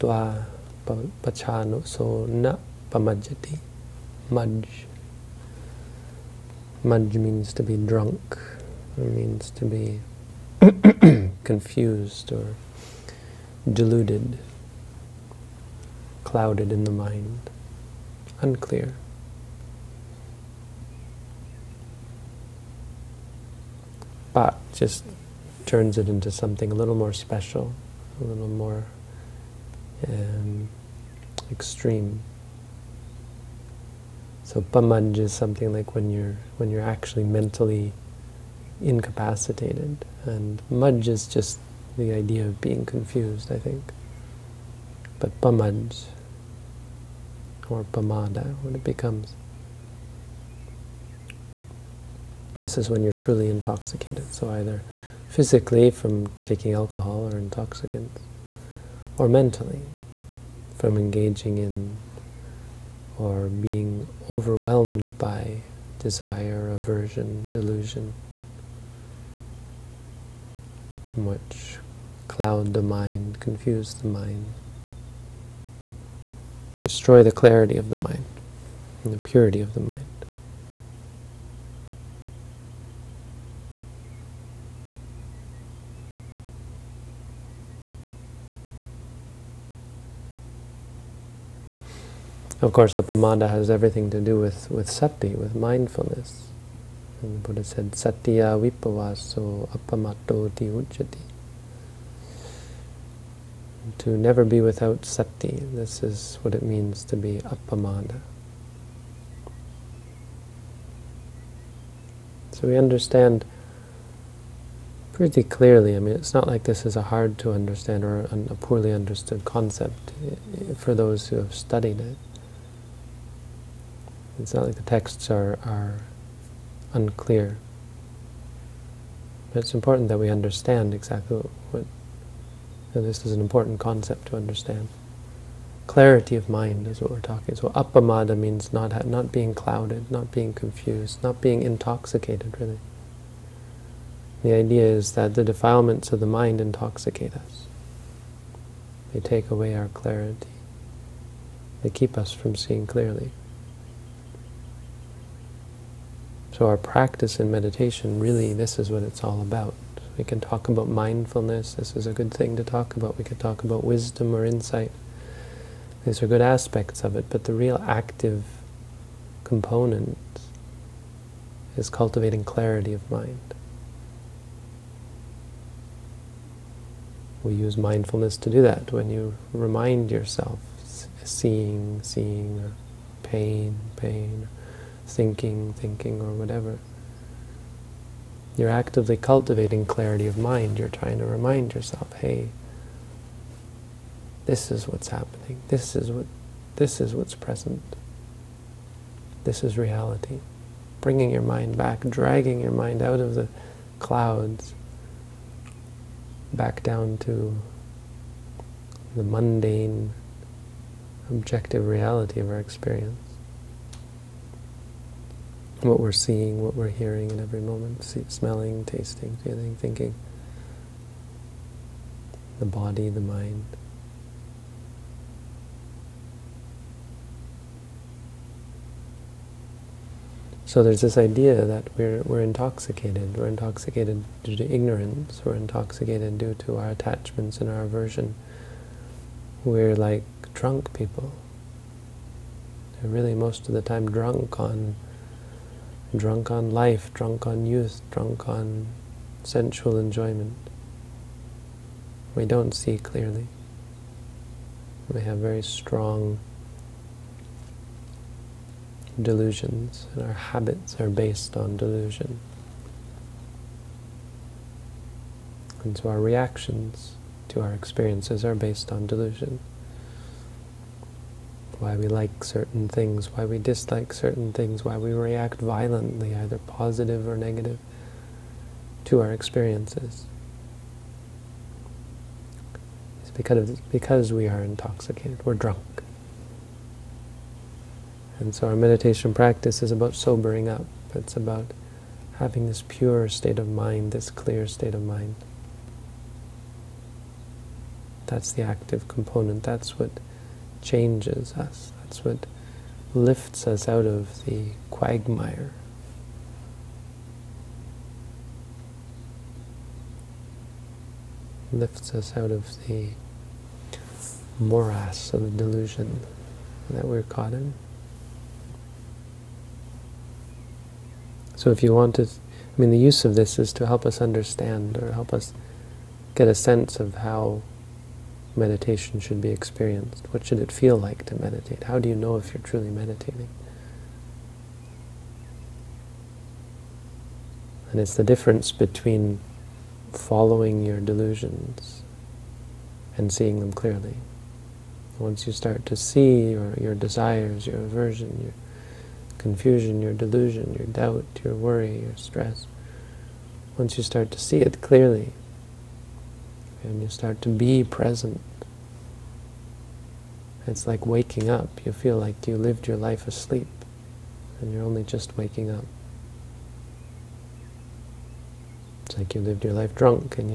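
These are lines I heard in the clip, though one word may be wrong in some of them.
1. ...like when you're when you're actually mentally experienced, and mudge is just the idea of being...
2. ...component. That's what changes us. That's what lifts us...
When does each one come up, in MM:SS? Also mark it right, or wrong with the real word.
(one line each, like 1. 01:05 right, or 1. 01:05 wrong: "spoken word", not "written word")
1. 00:35 wrong: "incapacitated", not "experienced"
2. 04:59 right.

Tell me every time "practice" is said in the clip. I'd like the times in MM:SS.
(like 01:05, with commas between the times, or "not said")
02:36, 04:49.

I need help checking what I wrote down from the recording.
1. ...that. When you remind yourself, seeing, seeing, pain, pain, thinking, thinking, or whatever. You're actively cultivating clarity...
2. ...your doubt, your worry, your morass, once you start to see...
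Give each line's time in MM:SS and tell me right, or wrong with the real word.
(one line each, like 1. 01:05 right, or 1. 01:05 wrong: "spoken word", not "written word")
1. 02:58 right
2. 05:50 wrong: "stress", not "morass".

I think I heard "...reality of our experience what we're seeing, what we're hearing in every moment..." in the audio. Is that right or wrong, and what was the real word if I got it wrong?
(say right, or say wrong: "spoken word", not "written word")
right.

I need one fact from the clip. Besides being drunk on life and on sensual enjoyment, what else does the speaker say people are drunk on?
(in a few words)
youth.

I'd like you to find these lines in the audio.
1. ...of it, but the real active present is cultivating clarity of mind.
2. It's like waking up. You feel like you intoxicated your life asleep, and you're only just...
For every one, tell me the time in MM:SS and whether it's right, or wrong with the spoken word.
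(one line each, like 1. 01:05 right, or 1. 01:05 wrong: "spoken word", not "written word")
1. 02:47 wrong: "component", not "present"
2. 06:00 wrong: "lived", not "intoxicated".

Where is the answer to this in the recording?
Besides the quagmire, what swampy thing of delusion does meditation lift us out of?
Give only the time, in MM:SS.
05:14.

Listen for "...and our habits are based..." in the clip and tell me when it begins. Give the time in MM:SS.
04:20.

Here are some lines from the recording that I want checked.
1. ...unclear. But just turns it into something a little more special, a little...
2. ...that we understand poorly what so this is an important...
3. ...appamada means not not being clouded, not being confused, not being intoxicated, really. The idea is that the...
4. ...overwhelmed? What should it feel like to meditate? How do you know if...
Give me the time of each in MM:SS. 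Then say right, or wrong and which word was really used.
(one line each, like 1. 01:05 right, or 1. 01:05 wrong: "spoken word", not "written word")
1. 00:18 right
2. 02:10 wrong: "exactly", not "poorly"
3. 02:17 right
4. 05:29 wrong: "experienced", not "overwhelmed".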